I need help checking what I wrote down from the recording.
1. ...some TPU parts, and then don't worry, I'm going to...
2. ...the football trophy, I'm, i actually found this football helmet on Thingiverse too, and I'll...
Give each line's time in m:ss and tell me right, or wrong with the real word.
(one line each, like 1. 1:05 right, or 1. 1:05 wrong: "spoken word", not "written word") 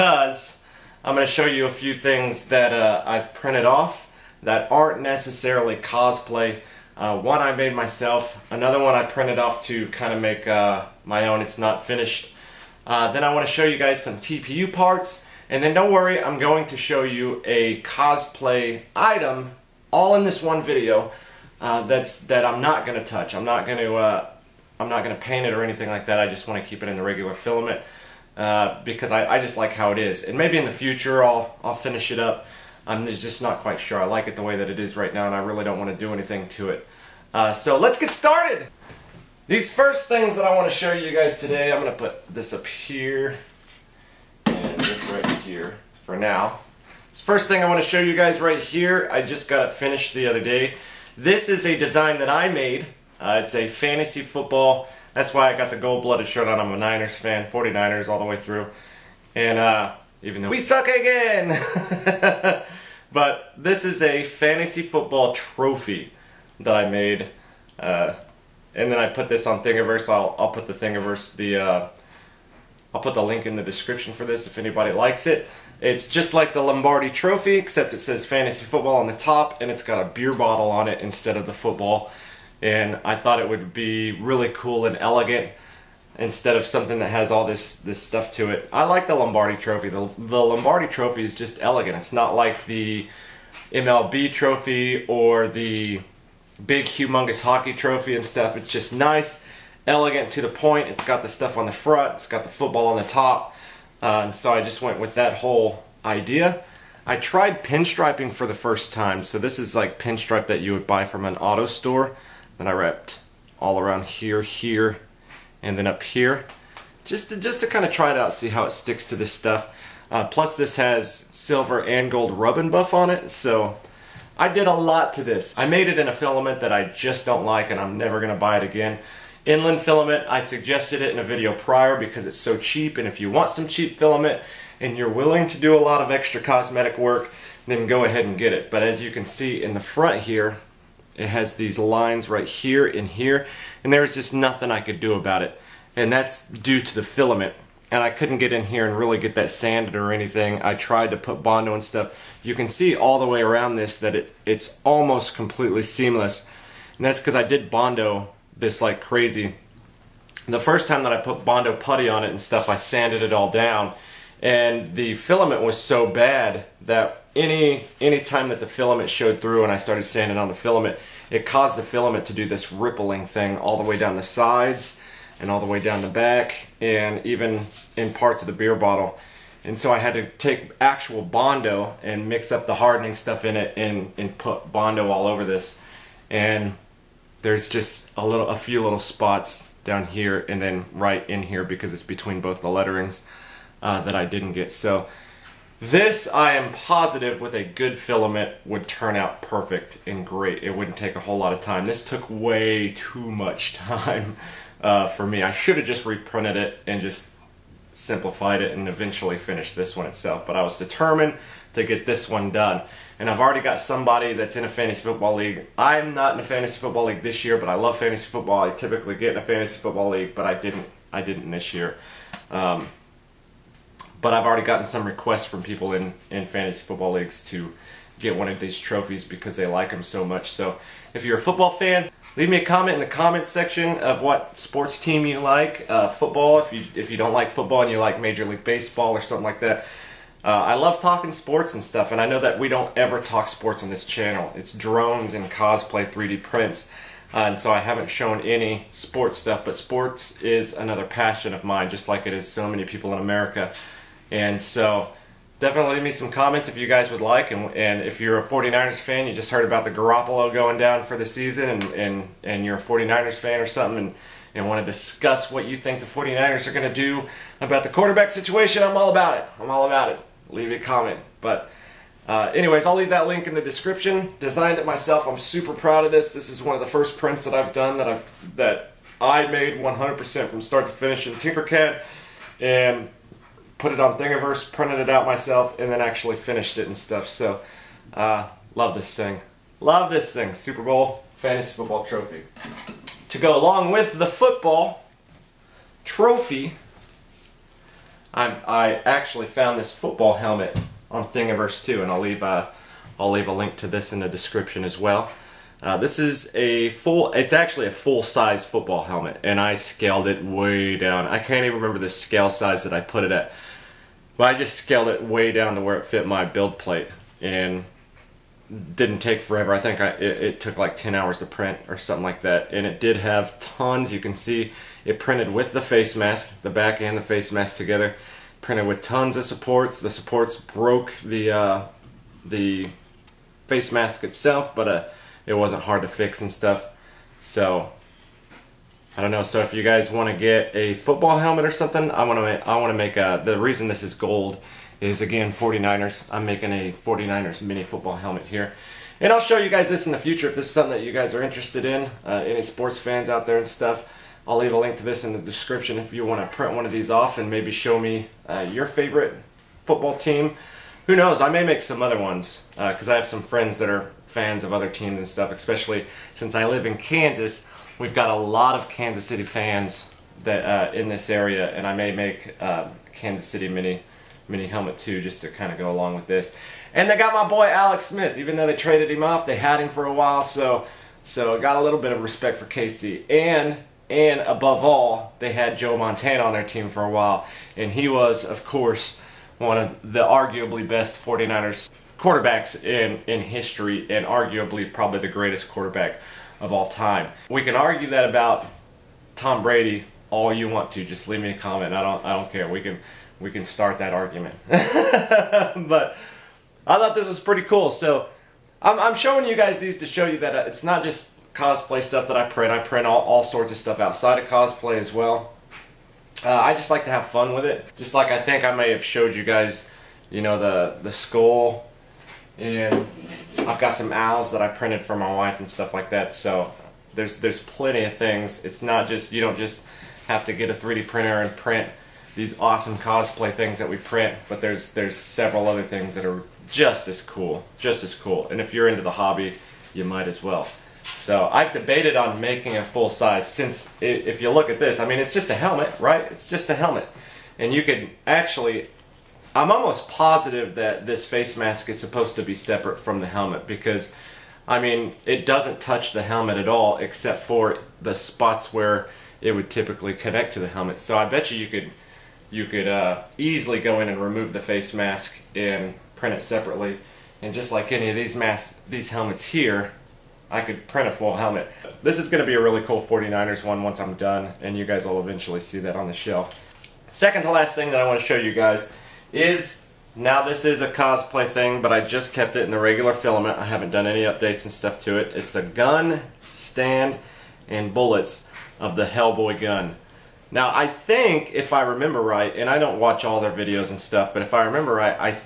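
1. 0:14 right
2. 4:54 right.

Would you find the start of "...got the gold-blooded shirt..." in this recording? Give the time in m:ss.
0:55.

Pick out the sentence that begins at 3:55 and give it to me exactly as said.
Uh, football, if you, if you don't like football and you like Major League Baseball or something like that.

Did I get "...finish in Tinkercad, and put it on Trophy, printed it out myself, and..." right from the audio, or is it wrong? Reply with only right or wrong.
wrong.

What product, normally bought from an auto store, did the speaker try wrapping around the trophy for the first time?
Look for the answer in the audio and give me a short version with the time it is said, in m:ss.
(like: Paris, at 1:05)
Pinstripe, at 1:49.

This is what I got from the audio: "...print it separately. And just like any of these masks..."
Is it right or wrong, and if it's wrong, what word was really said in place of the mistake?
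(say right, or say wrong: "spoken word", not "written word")
right.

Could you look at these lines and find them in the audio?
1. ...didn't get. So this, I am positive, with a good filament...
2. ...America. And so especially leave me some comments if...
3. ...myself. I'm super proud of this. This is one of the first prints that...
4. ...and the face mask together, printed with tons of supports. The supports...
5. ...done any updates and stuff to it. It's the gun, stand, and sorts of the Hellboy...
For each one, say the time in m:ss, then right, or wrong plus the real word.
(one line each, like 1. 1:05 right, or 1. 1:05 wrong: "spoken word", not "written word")
1. 3:14 right
2. 4:13 wrong: "definitely", not "especially"
3. 4:34 right
4. 5:27 right
5. 8:03 wrong: "bullets", not "sorts".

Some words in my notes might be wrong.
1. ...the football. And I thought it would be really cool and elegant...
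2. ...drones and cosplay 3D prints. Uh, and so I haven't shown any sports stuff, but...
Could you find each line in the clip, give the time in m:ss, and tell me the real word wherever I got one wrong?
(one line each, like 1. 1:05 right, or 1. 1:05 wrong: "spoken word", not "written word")
1. 1:21 right
2. 4:04 right.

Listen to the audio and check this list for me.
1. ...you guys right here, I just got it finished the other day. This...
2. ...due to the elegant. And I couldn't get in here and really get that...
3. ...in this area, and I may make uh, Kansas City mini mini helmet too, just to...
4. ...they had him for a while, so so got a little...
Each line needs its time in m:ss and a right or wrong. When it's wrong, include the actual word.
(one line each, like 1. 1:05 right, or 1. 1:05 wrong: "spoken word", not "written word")
1. 0:48 right
2. 2:26 wrong: "filament", not "elegant"
3. 6:10 right
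4. 6:19 right.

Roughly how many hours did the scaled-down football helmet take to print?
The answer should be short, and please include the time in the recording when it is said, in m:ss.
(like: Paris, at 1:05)
10, at 5:20.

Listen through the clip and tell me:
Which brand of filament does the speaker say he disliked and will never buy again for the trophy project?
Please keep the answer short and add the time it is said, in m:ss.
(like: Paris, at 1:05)
Inland, at 2:09.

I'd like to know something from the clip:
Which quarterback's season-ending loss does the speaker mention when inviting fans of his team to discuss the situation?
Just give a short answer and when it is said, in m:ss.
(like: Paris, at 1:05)
Garoppolo, at 4:19.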